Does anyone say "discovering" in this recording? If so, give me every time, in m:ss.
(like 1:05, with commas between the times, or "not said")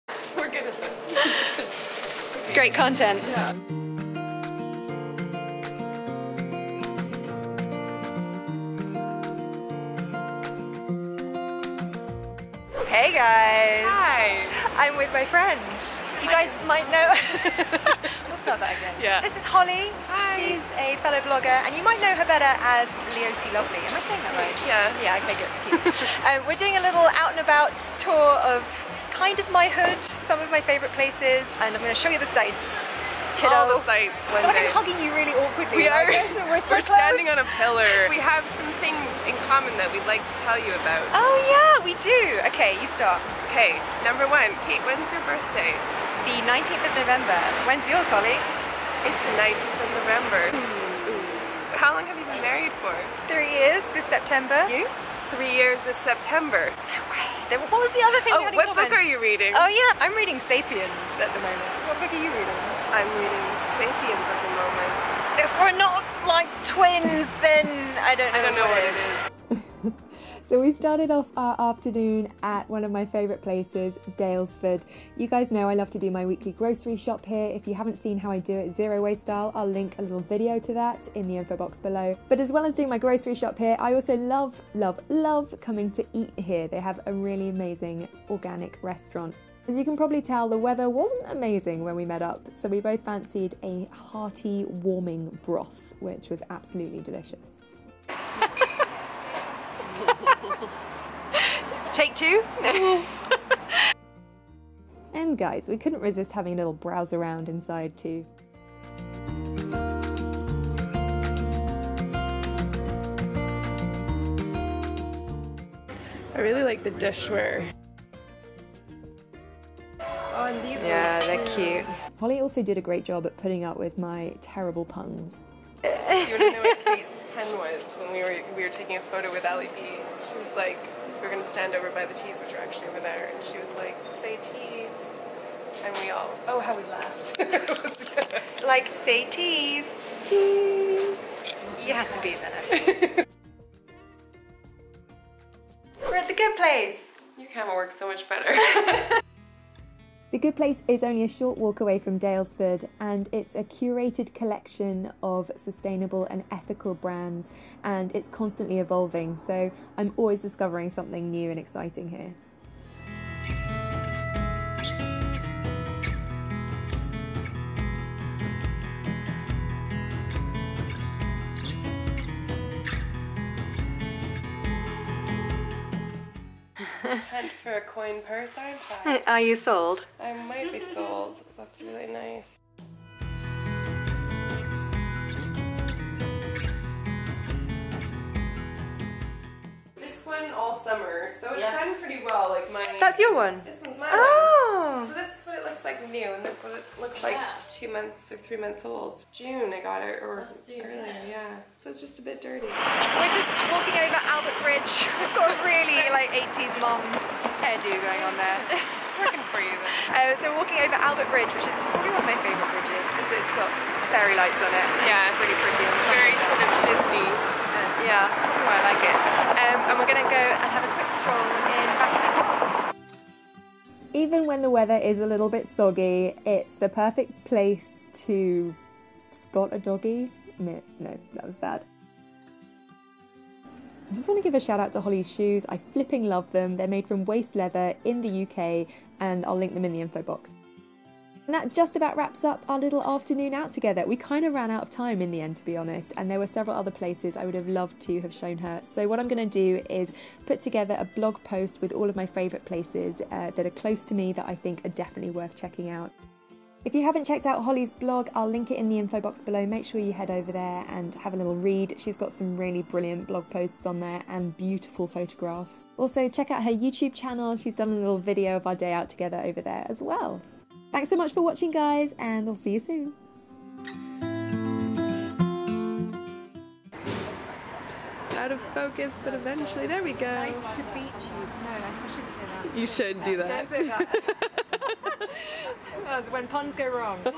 2:40.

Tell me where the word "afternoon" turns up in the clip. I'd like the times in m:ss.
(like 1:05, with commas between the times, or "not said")
1:11, 4:03.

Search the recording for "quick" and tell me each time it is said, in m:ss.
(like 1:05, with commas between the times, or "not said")
3:40.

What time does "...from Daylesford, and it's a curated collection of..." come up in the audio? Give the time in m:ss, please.
2:31.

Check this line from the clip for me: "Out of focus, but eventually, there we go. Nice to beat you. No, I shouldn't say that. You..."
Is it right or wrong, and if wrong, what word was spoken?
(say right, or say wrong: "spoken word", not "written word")
right.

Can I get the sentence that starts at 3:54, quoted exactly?
I just want to give a shout out to Holly's shoes.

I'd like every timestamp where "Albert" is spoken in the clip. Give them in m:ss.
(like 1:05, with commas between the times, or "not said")
3:24, 3:30.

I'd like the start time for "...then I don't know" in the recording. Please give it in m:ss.
1:07.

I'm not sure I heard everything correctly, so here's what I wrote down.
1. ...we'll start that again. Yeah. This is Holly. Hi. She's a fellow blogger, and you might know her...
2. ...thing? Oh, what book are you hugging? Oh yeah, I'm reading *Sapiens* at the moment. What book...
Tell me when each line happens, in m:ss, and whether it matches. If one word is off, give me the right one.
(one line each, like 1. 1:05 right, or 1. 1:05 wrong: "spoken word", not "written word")
1. 0:18 right
2. 0:58 wrong: "reading", not "hugging".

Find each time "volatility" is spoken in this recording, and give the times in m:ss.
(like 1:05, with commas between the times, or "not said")
not said.